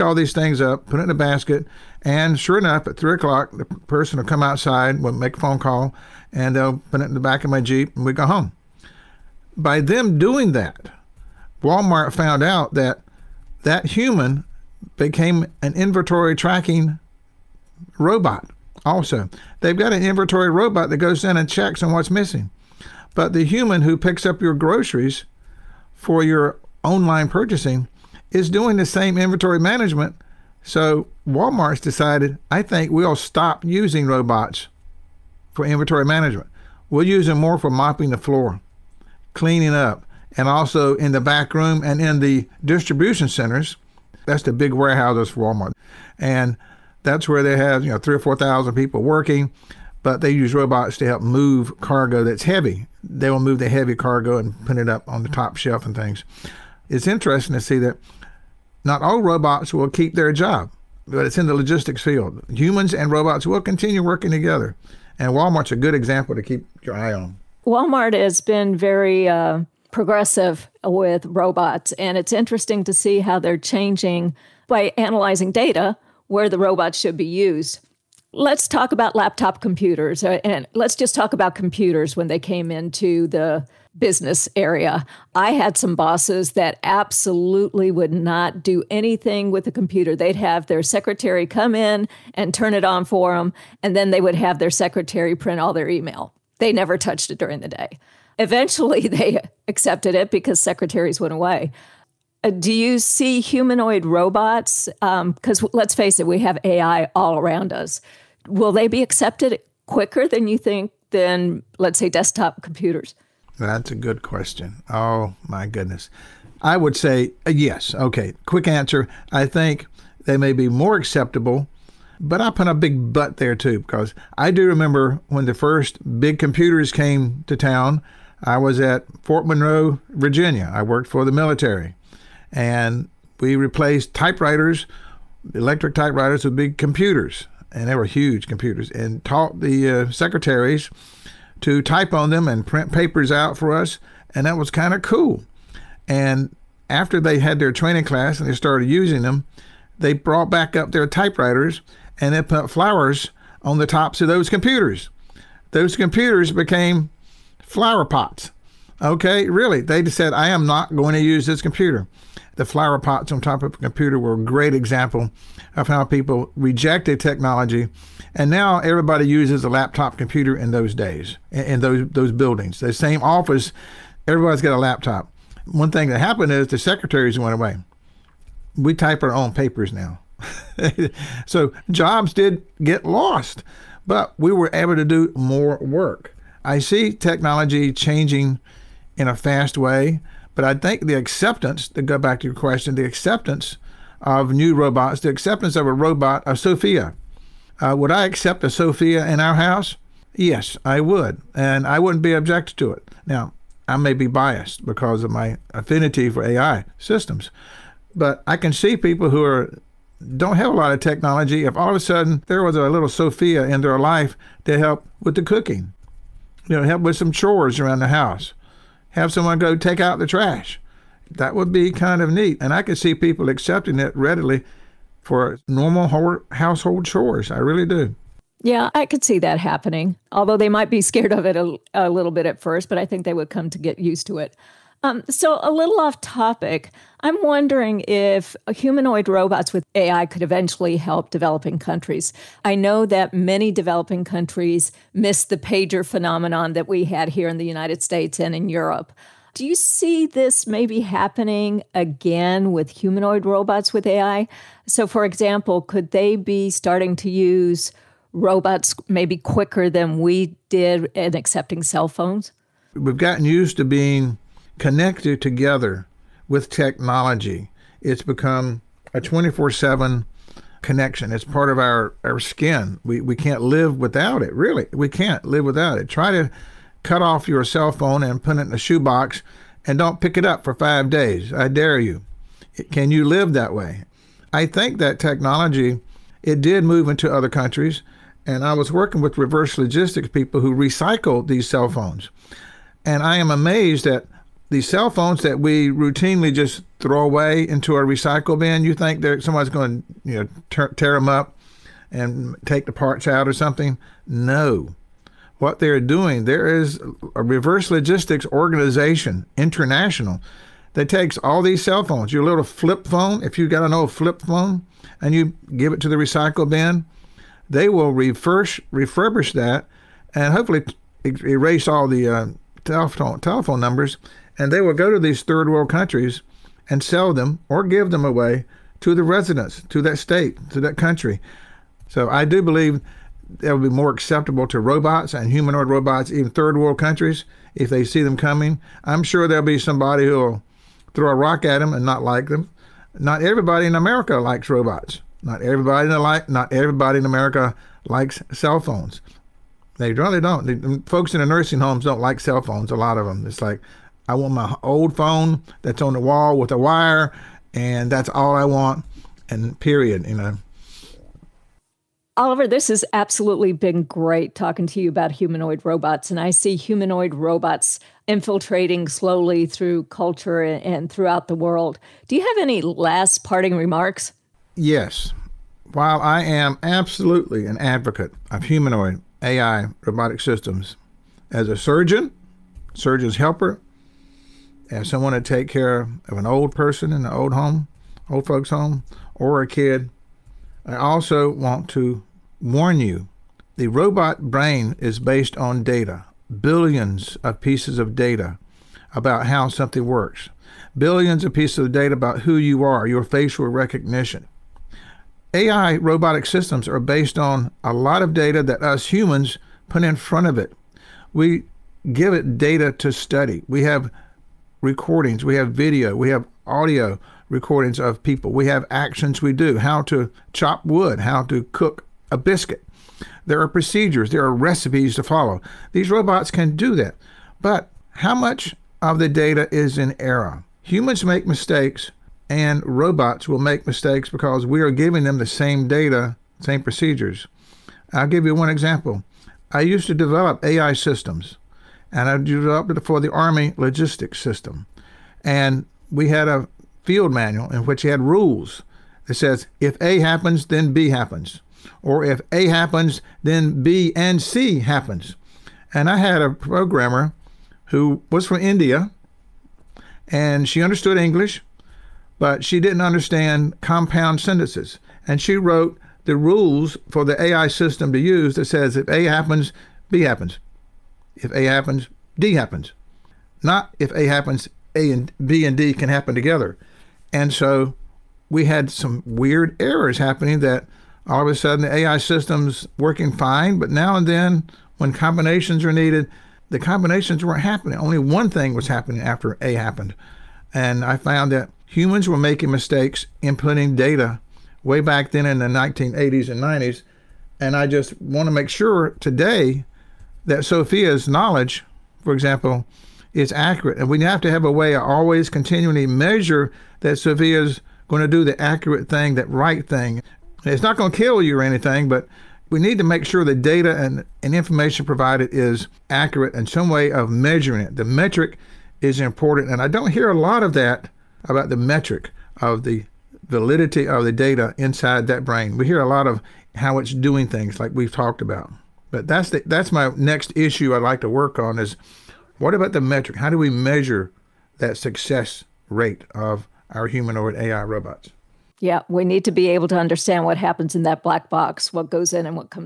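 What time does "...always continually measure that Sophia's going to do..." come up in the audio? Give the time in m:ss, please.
8:25.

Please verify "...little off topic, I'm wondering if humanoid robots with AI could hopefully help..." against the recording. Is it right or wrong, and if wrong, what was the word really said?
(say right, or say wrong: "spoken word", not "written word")
wrong: "eventually", not "hopefully".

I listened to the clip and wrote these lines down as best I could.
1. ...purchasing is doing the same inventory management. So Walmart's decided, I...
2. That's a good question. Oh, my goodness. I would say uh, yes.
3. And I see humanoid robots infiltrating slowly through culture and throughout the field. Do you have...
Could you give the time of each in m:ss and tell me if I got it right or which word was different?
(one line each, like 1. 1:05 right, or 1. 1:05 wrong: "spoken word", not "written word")
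1. 0:27 right
2. 1:53 right
3. 6:06 wrong: "world", not "field".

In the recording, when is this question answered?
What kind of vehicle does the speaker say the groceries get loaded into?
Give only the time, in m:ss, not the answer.
0:07.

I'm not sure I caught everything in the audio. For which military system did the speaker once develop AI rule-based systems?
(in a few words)
Army logistics system.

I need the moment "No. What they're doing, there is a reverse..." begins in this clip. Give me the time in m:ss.
5:04.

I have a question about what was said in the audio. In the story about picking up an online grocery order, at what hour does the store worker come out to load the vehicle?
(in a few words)
3 o'clock.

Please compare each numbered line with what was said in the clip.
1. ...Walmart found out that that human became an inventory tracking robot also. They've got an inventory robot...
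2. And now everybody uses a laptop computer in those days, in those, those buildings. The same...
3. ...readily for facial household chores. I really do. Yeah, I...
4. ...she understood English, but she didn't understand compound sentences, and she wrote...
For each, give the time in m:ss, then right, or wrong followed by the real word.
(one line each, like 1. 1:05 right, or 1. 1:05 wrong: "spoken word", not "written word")
1. 0:11 right
2. 2:48 right
3. 3:44 wrong: "normal", not "facial"
4. 7:40 right.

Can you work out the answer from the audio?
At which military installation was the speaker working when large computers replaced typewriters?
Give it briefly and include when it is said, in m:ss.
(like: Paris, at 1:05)
Fort Monroe, Virginia, at 2:09.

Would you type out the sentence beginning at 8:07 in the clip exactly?
Only one thing was happening after A happened.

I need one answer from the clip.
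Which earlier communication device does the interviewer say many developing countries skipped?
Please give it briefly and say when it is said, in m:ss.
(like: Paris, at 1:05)
pager, at 4:05.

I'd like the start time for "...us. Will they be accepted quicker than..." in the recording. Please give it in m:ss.
1:47.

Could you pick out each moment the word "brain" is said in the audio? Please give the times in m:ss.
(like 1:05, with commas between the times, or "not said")
6:34, 8:45.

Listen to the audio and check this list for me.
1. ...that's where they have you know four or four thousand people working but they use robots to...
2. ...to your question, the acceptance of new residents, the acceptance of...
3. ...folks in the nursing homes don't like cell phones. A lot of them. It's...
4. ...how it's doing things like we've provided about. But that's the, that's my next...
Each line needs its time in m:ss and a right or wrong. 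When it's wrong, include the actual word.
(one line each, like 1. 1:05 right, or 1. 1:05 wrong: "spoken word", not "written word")
1. 0:47 wrong: "three", not "four"
2. 3:12 wrong: "robots", not "residents"
3. 5:51 right
4. 8:46 wrong: "talked", not "provided".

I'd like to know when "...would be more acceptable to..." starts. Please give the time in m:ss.
5:33.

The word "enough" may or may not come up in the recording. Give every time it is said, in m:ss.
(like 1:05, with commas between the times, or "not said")
0:02.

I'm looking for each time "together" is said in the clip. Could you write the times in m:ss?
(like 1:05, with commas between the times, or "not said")
1:04, 4:25, 7:56.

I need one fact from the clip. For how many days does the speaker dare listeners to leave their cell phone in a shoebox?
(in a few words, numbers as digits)
5.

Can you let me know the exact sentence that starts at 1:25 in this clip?
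I had some bosses that absolutely would not do anything with a the computer.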